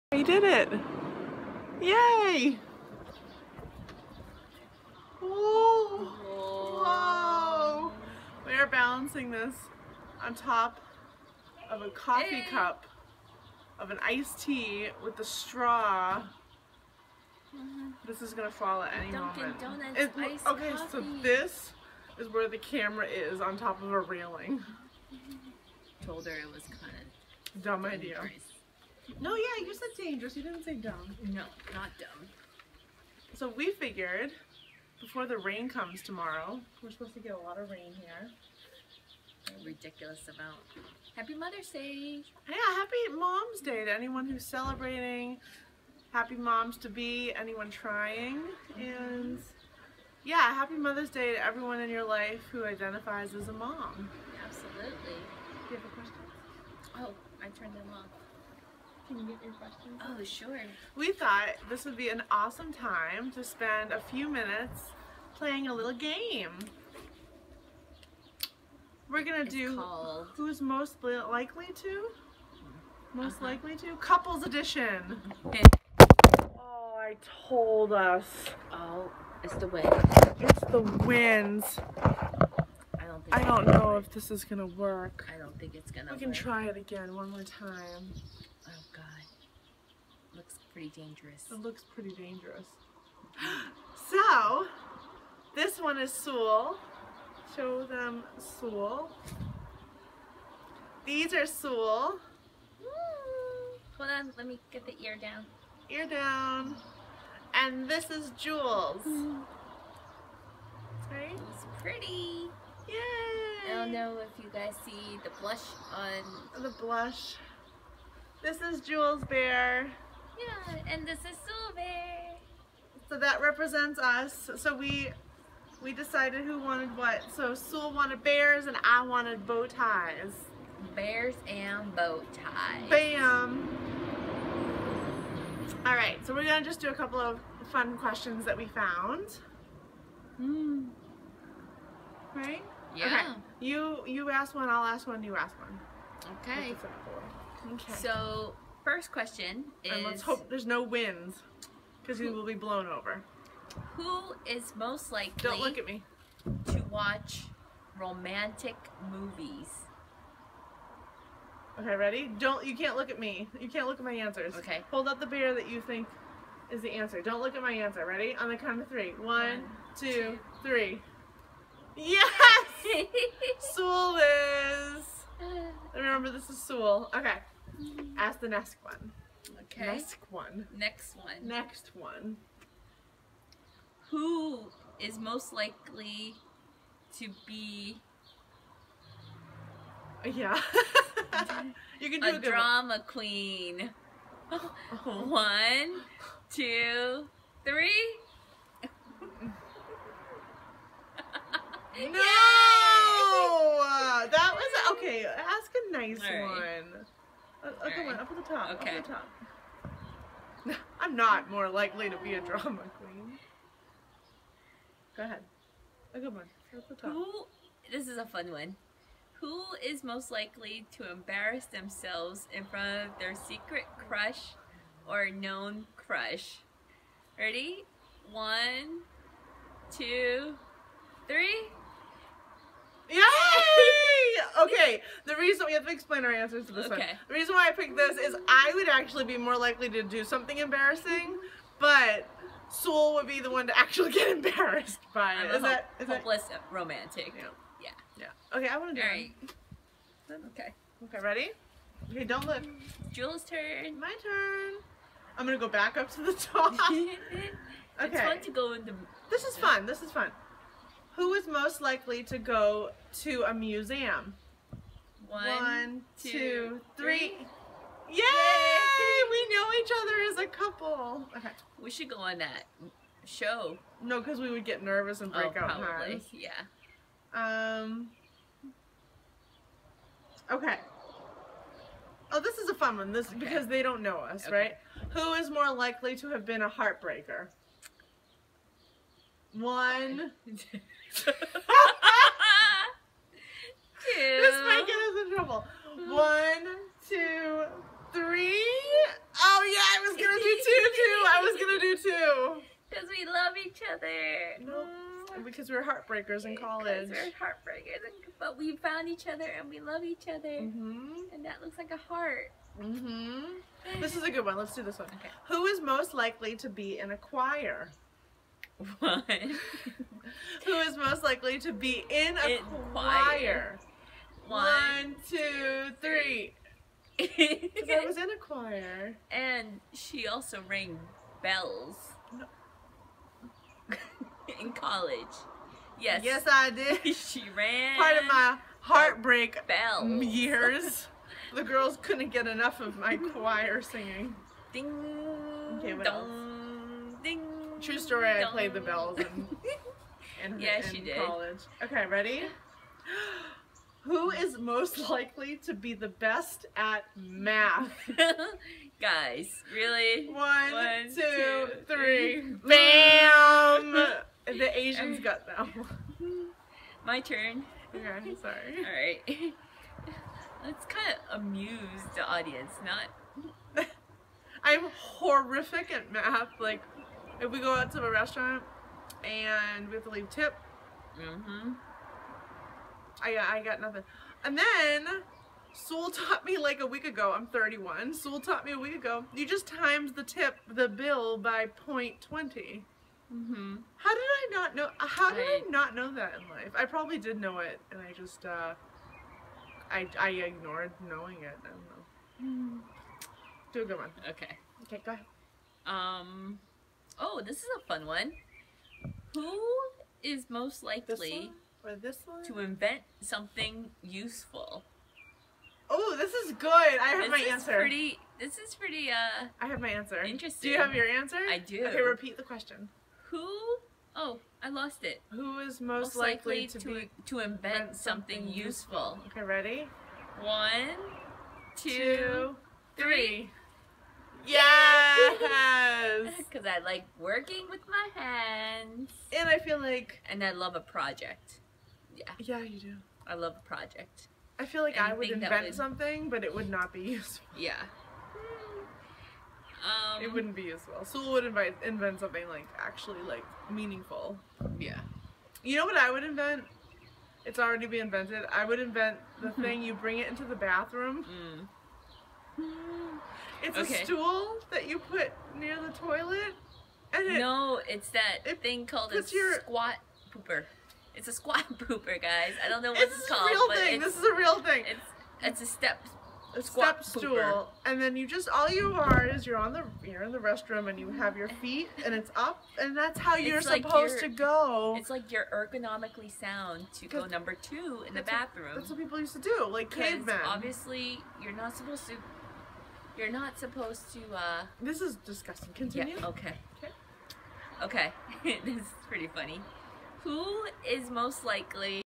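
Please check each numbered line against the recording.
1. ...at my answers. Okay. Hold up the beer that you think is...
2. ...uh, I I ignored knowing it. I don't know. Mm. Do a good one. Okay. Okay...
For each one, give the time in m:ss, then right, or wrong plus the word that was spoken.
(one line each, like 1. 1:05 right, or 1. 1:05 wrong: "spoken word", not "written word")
1. 2:43 right
2. 6:38 right.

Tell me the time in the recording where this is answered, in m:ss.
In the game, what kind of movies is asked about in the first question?
2:37.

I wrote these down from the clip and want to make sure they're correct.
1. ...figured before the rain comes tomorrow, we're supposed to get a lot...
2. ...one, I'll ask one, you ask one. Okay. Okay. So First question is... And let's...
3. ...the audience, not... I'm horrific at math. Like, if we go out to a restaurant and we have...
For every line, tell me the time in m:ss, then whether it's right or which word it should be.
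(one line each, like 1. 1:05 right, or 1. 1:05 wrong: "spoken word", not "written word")
1. 0:33 right
2. 2:24 right
3. 6:12 right.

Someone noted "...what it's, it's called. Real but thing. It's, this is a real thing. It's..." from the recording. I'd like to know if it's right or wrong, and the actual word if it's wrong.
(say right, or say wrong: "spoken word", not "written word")
right.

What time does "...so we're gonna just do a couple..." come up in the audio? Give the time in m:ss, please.
2:16.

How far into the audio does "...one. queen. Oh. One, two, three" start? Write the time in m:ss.
3:12.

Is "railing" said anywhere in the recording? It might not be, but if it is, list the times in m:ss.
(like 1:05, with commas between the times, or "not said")
0:24.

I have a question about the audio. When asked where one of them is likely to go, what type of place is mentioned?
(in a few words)
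A museum.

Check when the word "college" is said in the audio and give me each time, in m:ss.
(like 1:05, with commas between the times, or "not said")
5:06, 5:34, 5:51.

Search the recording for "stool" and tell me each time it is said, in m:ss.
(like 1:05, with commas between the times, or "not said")
7:44, 7:57.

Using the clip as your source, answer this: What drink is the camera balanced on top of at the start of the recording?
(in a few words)
Iced tea.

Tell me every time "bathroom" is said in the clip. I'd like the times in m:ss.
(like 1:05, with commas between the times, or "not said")
7:40, 8:08.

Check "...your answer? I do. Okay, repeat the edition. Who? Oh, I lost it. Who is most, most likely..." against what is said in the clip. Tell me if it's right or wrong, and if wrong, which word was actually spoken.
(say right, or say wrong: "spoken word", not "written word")
wrong: "question", not "edition".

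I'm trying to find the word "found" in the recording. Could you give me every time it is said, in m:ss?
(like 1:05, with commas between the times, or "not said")
2:18, 5:08.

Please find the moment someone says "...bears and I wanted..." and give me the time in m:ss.
2:08.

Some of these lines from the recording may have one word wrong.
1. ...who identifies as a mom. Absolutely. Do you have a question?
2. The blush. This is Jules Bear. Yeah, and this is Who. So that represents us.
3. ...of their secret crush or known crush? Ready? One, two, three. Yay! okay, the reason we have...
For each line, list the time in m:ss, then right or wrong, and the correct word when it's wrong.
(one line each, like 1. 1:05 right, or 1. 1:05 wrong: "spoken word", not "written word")
1. 0:52 right
2. 1:56 wrong: "Silver", not "Who"
3. 3:43 right.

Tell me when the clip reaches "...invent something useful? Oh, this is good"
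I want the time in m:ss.
6:52.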